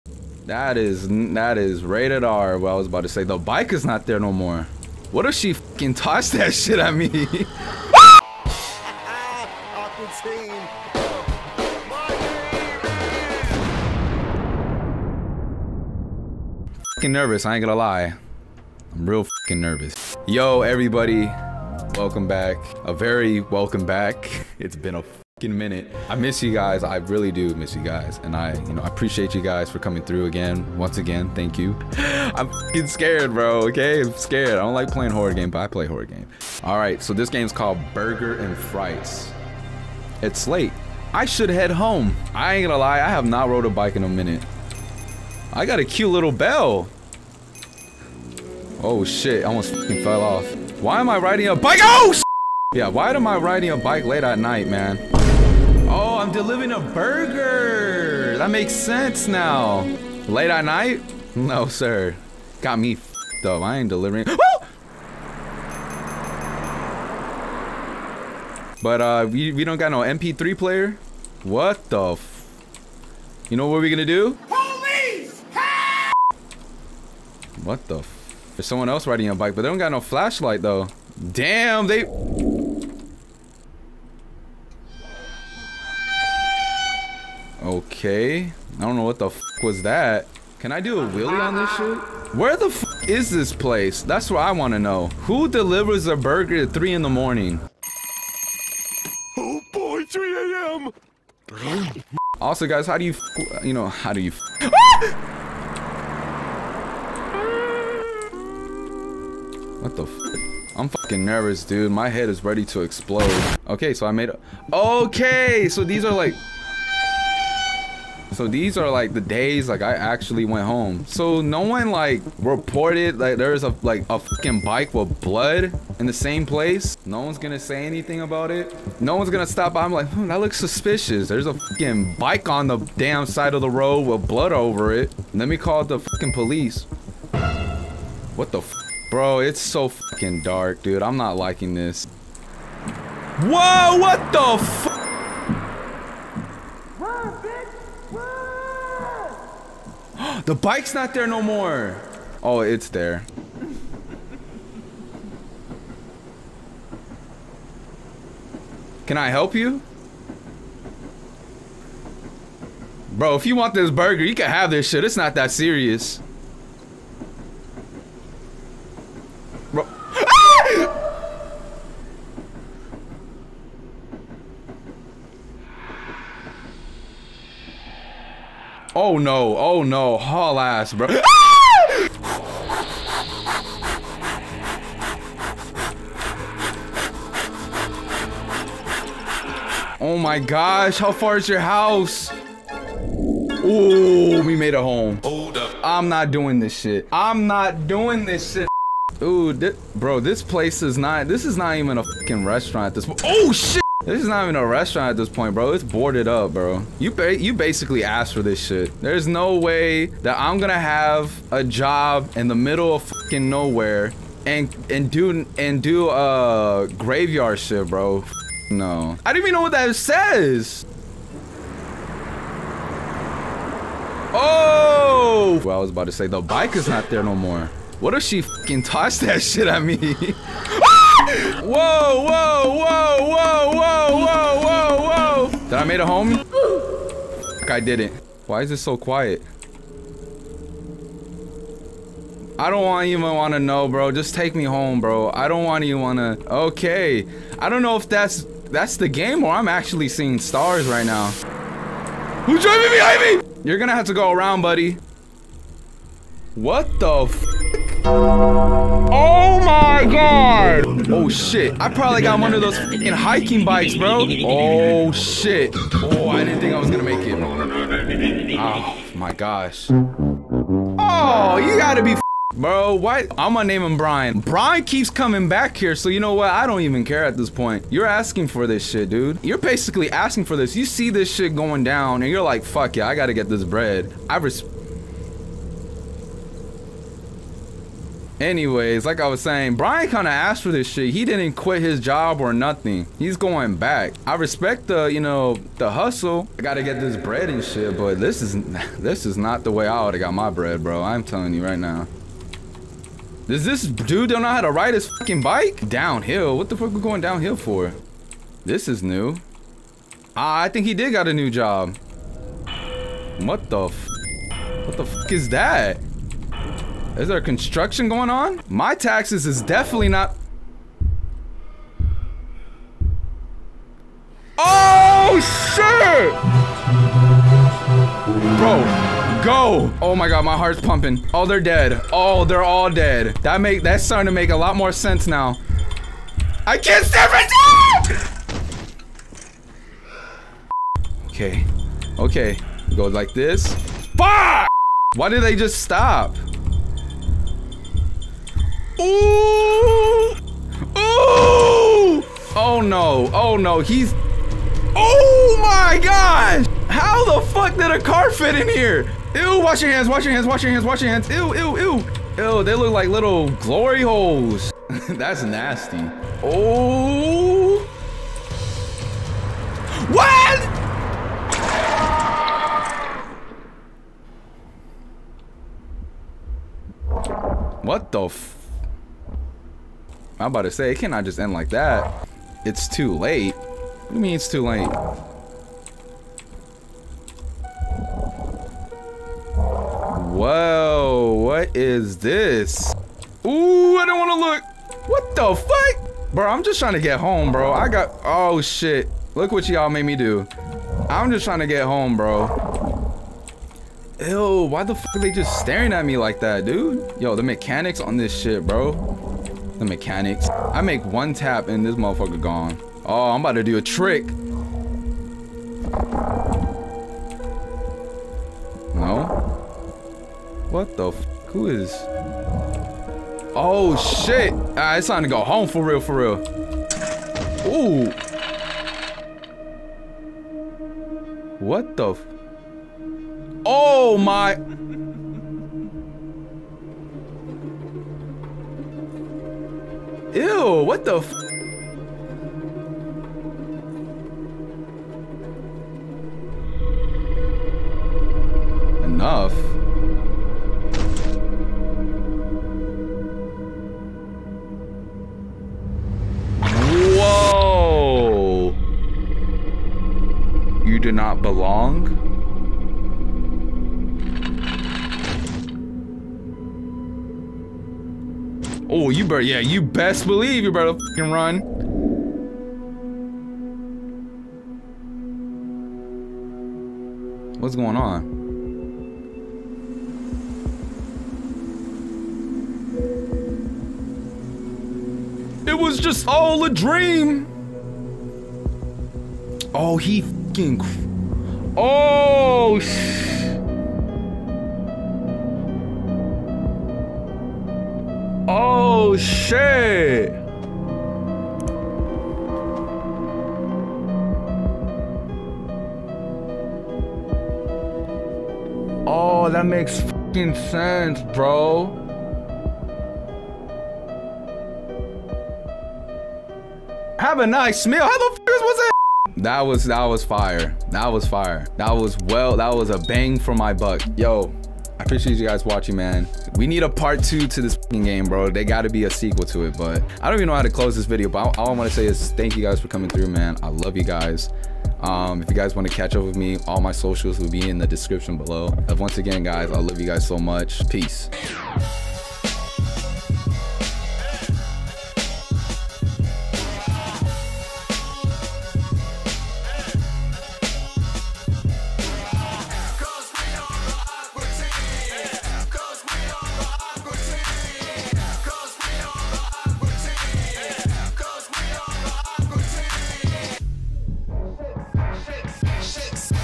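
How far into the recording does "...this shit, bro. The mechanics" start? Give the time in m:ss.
6:48.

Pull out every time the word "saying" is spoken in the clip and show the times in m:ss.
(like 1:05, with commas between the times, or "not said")
4:49.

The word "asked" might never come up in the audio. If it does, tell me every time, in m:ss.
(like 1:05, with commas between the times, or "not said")
3:28, 4:50.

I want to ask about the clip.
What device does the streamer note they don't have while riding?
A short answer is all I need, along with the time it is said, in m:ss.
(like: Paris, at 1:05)
MP3 player, at 1:09.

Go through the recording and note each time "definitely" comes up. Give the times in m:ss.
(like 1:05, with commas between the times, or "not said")
5:19.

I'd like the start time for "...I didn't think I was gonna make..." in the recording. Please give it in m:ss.
4:26.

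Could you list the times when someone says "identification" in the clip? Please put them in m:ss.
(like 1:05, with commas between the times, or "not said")
not said.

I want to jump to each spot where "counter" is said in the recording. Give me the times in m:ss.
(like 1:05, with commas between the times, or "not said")
not said.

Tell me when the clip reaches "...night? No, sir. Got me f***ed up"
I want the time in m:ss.
1:00.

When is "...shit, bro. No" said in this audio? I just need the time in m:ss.
3:37.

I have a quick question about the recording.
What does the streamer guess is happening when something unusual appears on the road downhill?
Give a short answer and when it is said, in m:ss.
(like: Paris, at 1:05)
Construction, at 5:17.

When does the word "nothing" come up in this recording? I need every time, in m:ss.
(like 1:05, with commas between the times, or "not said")
4:52.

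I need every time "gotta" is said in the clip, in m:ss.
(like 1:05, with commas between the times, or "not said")
4:31, 4:43, 4:56.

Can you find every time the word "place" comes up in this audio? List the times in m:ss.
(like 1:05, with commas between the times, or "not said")
1:33, 2:06, 3:20.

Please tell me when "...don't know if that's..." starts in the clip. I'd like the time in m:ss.
4:07.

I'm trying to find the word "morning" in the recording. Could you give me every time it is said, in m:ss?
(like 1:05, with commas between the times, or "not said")
1:37.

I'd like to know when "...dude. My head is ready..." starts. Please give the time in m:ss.
1:51.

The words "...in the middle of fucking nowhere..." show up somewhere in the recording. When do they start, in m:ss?
3:32.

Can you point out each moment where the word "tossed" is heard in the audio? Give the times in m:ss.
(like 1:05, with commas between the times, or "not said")
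0:05, 3:48.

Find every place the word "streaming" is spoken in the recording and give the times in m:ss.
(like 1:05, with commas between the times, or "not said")
not said.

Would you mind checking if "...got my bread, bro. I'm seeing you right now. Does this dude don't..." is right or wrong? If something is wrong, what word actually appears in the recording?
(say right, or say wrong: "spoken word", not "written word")
wrong: "telling", not "seeing".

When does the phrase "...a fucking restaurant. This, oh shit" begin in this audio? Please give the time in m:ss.
3:21.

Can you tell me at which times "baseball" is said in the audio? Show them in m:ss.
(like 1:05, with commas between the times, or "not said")
not said.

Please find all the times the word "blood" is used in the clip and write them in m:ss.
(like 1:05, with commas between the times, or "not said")
2:05, 2:14.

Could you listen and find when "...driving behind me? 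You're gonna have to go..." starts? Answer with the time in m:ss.
4:12.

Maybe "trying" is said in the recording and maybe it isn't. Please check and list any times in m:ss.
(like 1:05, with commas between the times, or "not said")
6:36, 6:41.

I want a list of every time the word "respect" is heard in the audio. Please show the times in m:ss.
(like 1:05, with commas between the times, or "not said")
4:44, 4:54.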